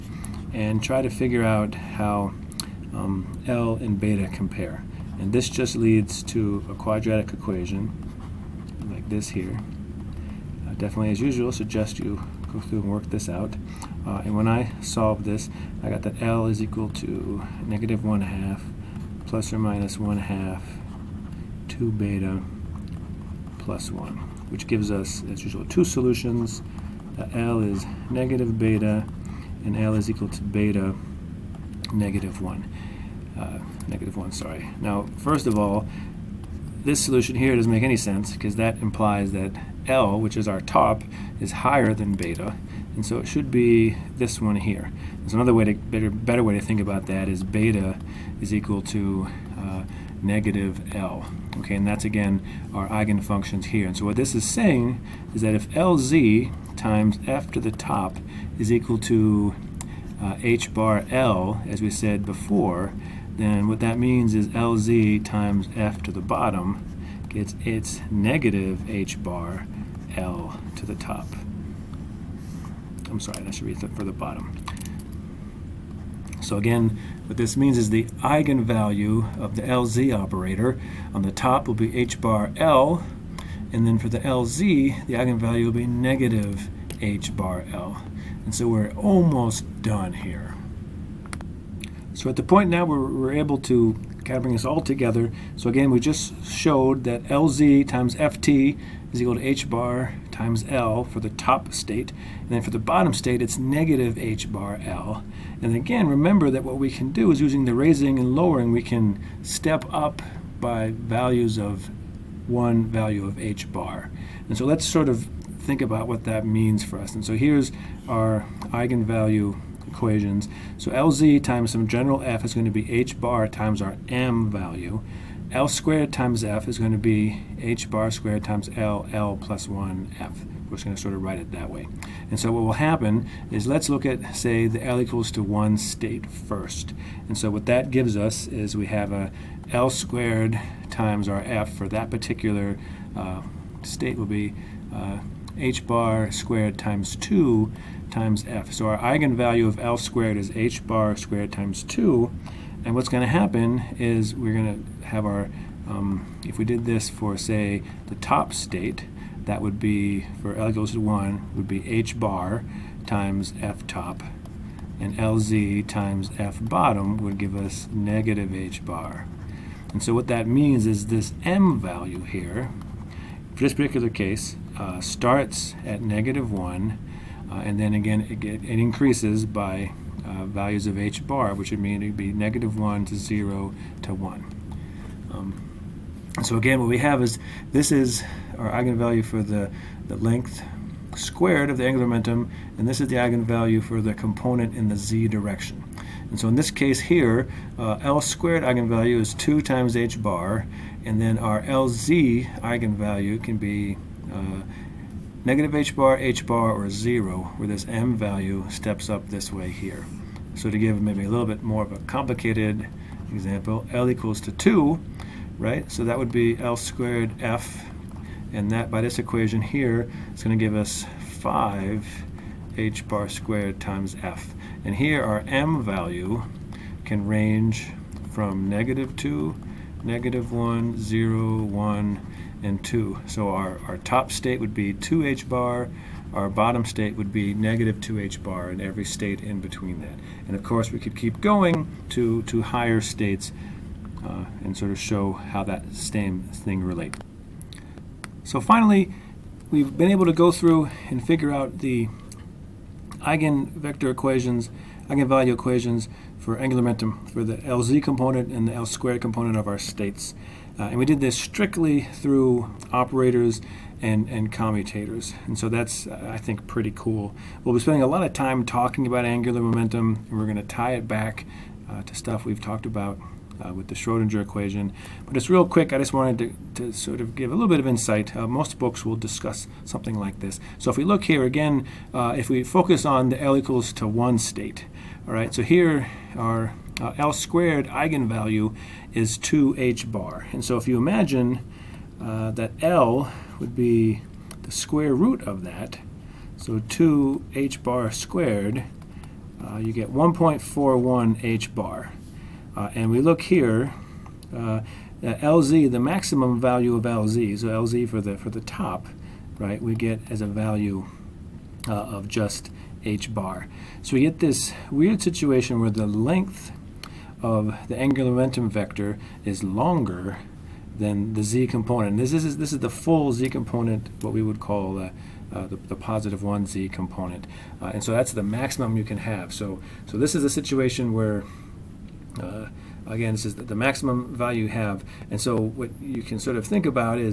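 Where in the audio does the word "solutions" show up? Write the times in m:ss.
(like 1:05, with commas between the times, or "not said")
0:25, 0:37.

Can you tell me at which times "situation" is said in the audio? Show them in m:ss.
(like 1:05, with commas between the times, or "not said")
5:15, 5:30.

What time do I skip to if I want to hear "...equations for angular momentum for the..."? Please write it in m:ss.
4:15.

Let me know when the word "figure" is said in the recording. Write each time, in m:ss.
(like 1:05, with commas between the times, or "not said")
0:01, 4:11.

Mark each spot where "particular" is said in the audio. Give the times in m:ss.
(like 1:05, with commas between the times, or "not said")
2:22, 2:53.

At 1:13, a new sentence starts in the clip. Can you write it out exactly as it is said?
I'm sorry, that should be for the bottom.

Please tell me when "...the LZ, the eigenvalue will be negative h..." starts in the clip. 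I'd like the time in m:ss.
1:24.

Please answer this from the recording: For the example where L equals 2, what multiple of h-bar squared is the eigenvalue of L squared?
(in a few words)
5.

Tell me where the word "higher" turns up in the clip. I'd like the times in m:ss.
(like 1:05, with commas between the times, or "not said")
0:41, 4:02.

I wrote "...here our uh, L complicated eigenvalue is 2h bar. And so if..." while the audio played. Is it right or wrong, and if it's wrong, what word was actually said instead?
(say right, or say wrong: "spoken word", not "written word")
wrong: "squared", not "complicated".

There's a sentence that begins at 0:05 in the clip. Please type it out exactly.
And this just leads to a quadratic equation like this here.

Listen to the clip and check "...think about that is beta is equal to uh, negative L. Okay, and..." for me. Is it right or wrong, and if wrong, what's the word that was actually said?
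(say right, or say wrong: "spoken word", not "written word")
right.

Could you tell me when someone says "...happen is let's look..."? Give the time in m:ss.
2:12.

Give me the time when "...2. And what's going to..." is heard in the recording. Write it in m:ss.
2:31.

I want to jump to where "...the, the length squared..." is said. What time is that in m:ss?
3:09.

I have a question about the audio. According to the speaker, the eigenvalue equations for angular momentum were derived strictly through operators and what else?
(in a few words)
commutators.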